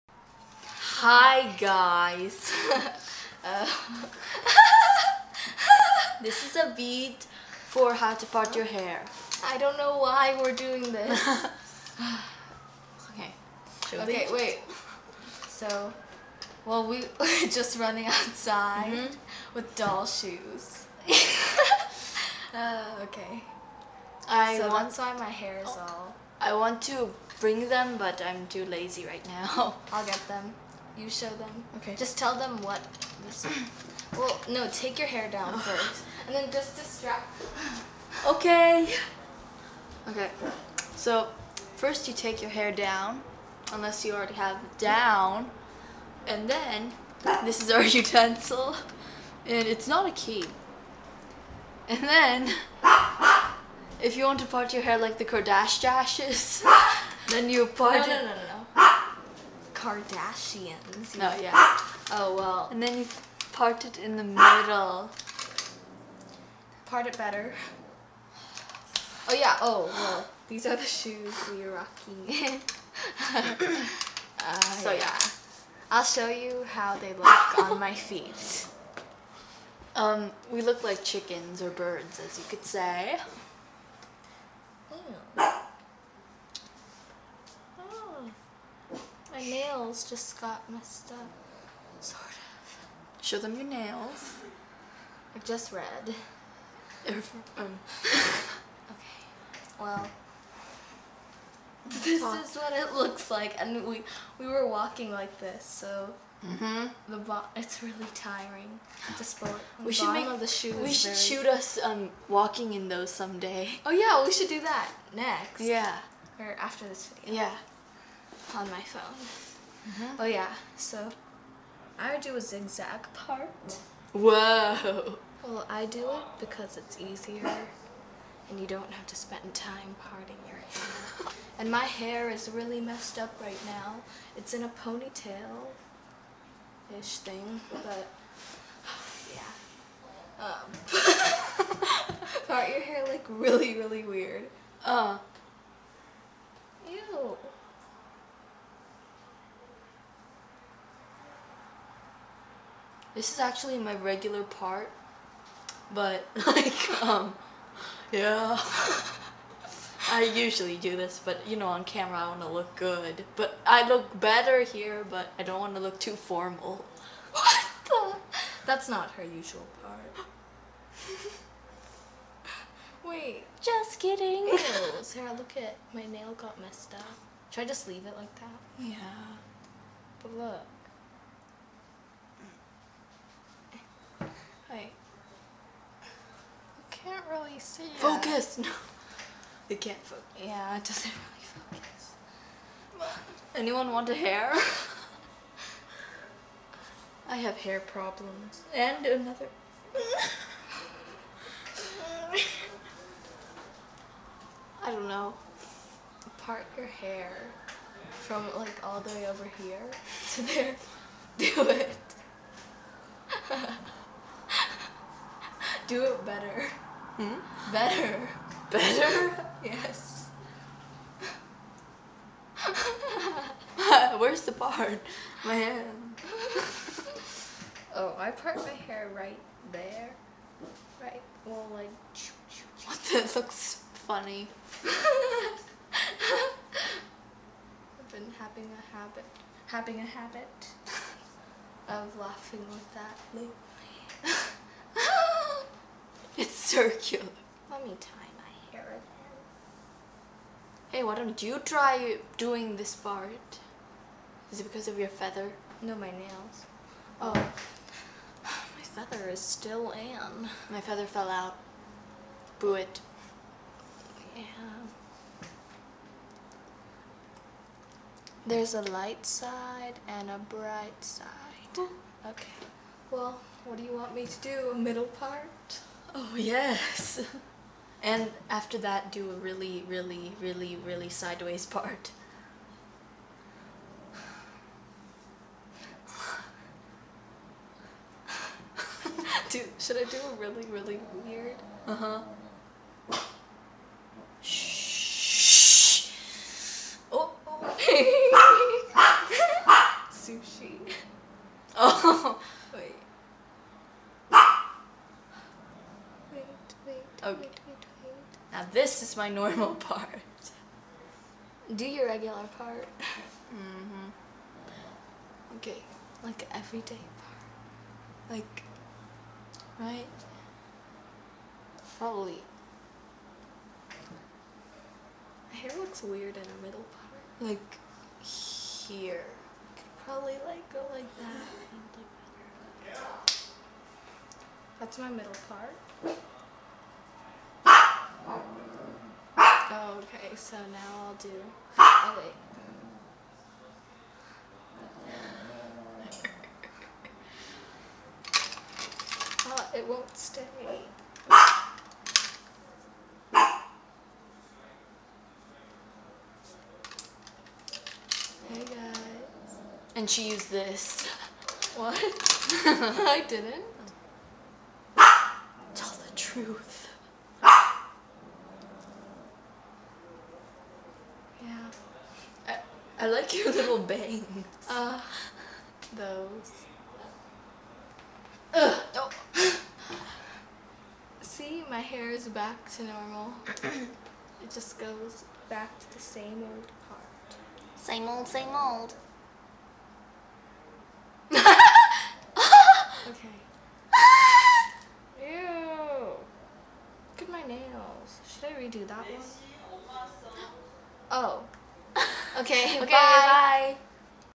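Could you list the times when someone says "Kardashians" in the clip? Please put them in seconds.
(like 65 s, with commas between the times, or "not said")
55 s, 59 s.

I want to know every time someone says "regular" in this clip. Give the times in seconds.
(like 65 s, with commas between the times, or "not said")
153 s, 312 s.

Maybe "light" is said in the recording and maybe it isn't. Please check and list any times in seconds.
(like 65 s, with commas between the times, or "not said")
268 s.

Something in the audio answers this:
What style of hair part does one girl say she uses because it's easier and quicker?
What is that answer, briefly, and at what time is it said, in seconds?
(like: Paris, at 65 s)
Zigzag part, at 122 s.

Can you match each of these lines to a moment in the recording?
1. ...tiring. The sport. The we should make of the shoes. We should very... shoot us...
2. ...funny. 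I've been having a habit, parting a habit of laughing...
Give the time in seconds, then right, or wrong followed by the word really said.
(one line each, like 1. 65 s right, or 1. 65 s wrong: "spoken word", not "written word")
1. 108 s right
2. 233 s wrong: "having", not "parting".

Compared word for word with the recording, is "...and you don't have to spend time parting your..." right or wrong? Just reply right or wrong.
right.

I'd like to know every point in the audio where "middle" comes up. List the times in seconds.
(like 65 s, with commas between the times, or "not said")
64 s, 274 s, 326 s, 335 s.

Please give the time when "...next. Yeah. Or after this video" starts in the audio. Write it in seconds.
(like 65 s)
115 s.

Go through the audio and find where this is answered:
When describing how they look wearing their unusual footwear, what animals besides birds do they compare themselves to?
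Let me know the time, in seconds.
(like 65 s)
81 s.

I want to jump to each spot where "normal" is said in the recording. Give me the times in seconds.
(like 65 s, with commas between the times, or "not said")
309 s, 382 s.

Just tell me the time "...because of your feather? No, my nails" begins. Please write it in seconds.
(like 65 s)
254 s.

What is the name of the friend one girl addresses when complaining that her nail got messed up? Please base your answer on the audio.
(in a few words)
Sarah.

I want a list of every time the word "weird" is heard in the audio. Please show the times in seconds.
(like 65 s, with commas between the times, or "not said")
144 s, 291 s, 326 s.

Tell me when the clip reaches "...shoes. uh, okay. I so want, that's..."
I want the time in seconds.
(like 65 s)
20 s.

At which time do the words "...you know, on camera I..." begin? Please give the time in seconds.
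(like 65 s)
161 s.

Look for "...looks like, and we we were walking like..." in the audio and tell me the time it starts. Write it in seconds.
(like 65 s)
102 s.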